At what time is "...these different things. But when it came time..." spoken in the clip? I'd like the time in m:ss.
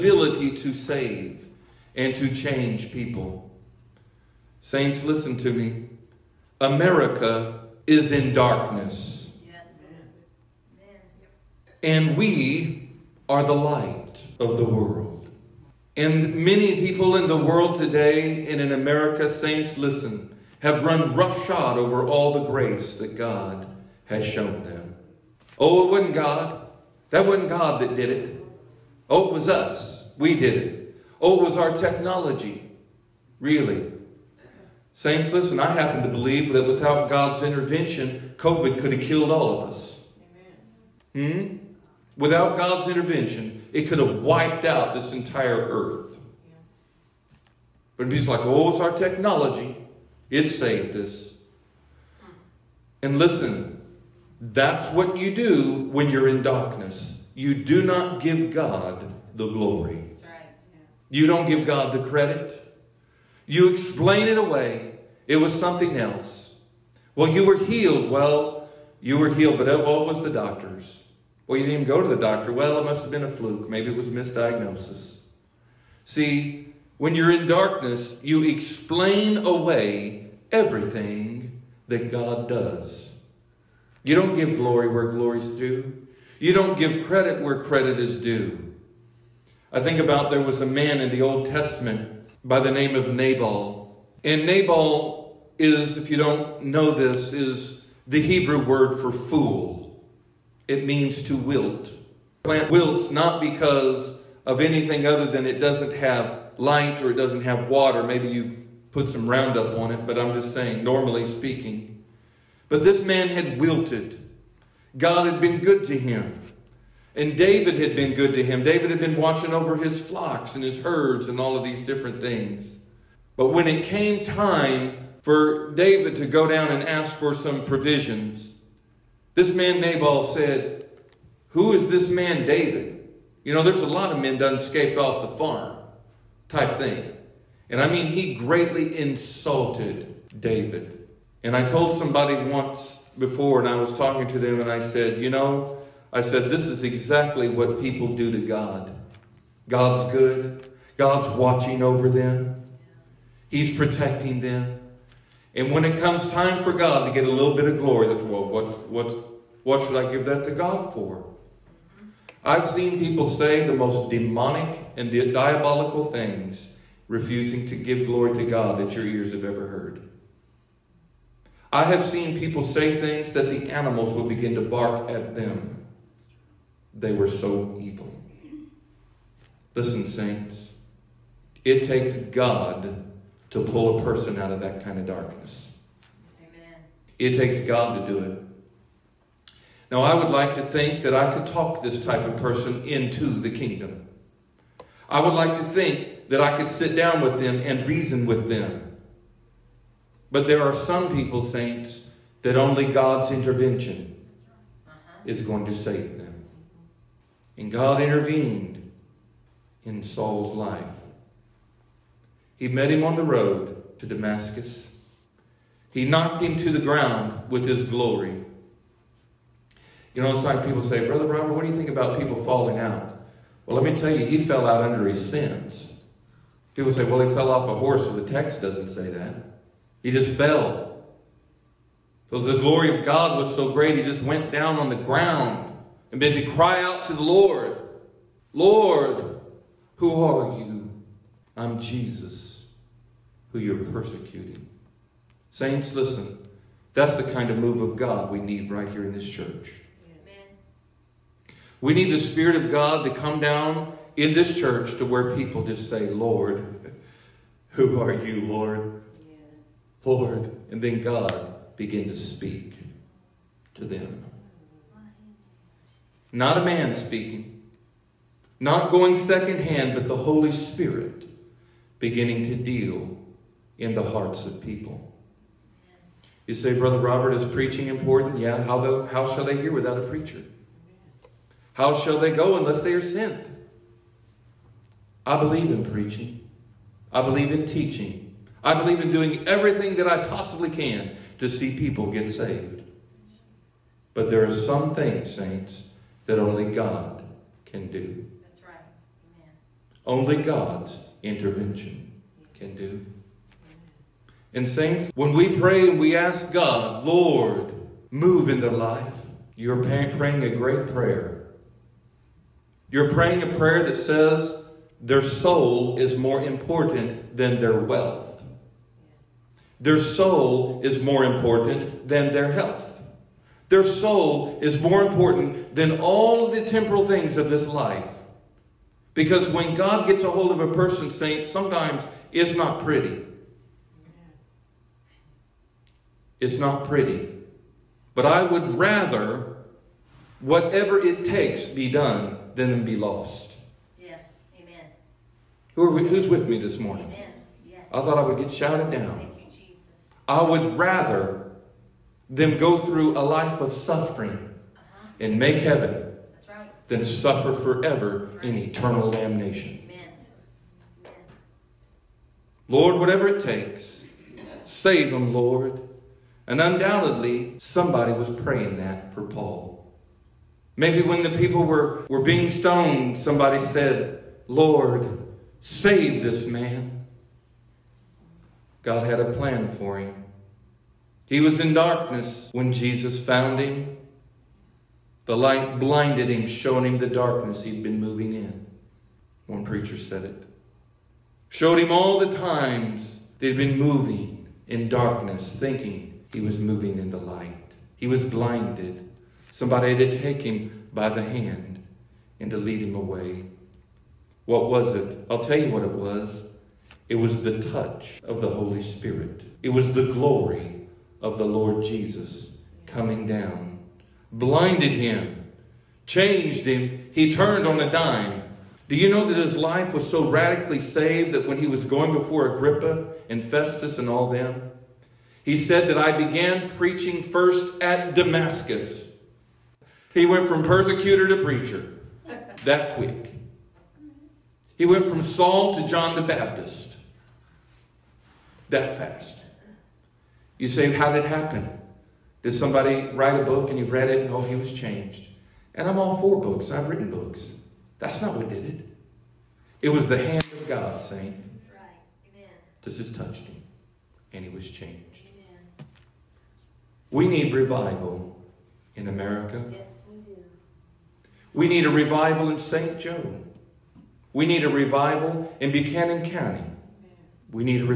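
2:01.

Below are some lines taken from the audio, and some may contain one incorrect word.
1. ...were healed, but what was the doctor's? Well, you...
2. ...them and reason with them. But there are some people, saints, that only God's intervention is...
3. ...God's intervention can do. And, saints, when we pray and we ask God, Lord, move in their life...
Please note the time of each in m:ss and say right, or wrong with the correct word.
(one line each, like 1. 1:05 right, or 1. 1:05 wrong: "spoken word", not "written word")
1. 1:09 right
2. 3:17 right
3. 5:00 right.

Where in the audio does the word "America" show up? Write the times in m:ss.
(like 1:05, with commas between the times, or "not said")
0:06, 0:18, 7:39.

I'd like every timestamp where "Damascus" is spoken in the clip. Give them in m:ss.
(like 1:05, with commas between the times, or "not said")
3:34, 7:08.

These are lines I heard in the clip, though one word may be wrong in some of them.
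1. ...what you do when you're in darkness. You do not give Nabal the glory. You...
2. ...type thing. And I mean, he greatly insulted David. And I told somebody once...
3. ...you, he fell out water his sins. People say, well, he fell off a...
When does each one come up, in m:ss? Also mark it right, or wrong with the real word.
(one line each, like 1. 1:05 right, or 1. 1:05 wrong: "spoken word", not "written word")
1. 0:54 wrong: "God", not "Nabal"
2. 2:16 right
3. 3:44 wrong: "under", not "water".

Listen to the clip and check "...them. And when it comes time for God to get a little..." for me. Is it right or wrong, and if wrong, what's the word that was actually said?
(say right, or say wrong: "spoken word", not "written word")
right.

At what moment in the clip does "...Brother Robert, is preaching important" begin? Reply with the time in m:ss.
4:36.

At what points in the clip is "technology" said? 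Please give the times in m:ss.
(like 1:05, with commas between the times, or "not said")
0:31, 0:48.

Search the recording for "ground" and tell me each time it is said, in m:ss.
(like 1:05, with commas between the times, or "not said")
3:36, 3:54.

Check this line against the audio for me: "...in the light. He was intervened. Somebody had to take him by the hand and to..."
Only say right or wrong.
wrong.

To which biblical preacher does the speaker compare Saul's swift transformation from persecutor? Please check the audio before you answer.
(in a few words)
John the Baptist.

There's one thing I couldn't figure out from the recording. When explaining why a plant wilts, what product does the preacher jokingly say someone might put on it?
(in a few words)
Roundup.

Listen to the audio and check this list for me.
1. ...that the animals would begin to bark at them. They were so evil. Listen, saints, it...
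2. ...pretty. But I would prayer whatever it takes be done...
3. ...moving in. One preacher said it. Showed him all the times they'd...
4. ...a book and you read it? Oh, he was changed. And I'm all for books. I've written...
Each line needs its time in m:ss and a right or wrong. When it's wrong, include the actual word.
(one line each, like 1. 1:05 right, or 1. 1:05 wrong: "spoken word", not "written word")
1. 2:53 right
2. 5:36 wrong: "rather", not "prayer"
3. 6:27 right
4. 7:23 right.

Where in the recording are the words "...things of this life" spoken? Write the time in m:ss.
5:27.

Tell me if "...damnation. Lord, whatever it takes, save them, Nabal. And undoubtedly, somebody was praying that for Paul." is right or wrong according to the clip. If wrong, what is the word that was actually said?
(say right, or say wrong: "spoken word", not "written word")
wrong: "Lord", not "Nabal".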